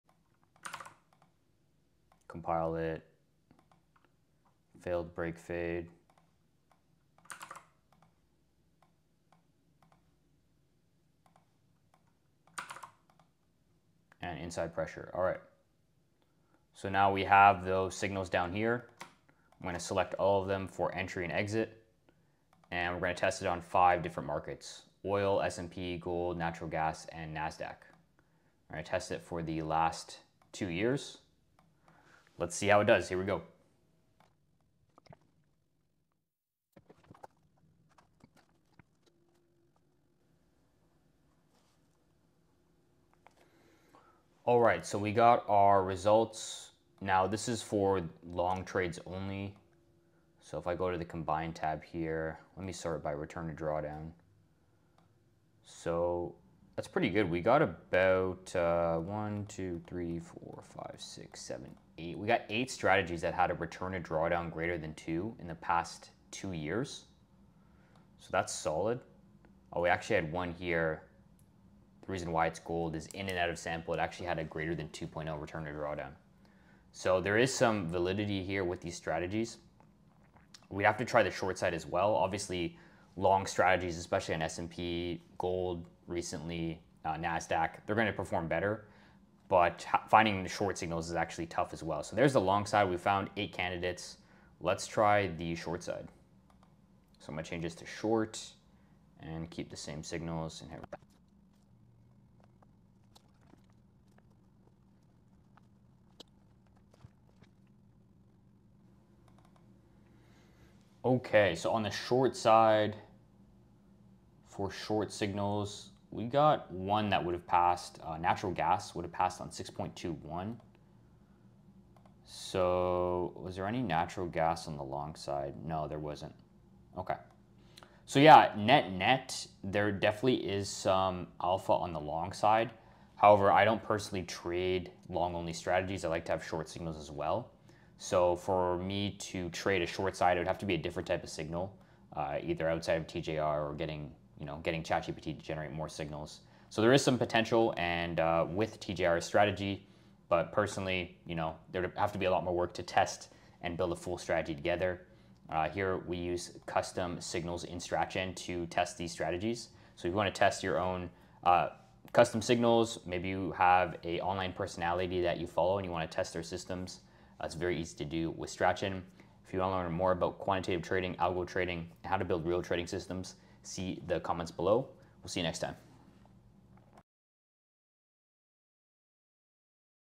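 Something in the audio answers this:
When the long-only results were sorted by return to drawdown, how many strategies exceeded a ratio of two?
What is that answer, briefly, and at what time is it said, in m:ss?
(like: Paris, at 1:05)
8, at 1:02.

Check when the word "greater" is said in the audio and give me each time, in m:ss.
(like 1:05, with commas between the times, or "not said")
1:04, 1:14.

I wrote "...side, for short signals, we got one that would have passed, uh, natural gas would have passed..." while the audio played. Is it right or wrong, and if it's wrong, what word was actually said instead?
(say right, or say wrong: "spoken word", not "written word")
right.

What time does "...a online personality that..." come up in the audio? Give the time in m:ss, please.
2:44.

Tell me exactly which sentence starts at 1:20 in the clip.
We'd have to try the short side as well.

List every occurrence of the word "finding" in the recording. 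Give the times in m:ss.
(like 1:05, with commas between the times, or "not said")
1:30.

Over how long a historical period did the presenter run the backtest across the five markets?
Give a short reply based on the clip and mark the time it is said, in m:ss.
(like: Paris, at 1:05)
2 years, at 0:29.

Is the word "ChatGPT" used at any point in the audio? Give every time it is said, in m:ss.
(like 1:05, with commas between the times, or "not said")
2:24.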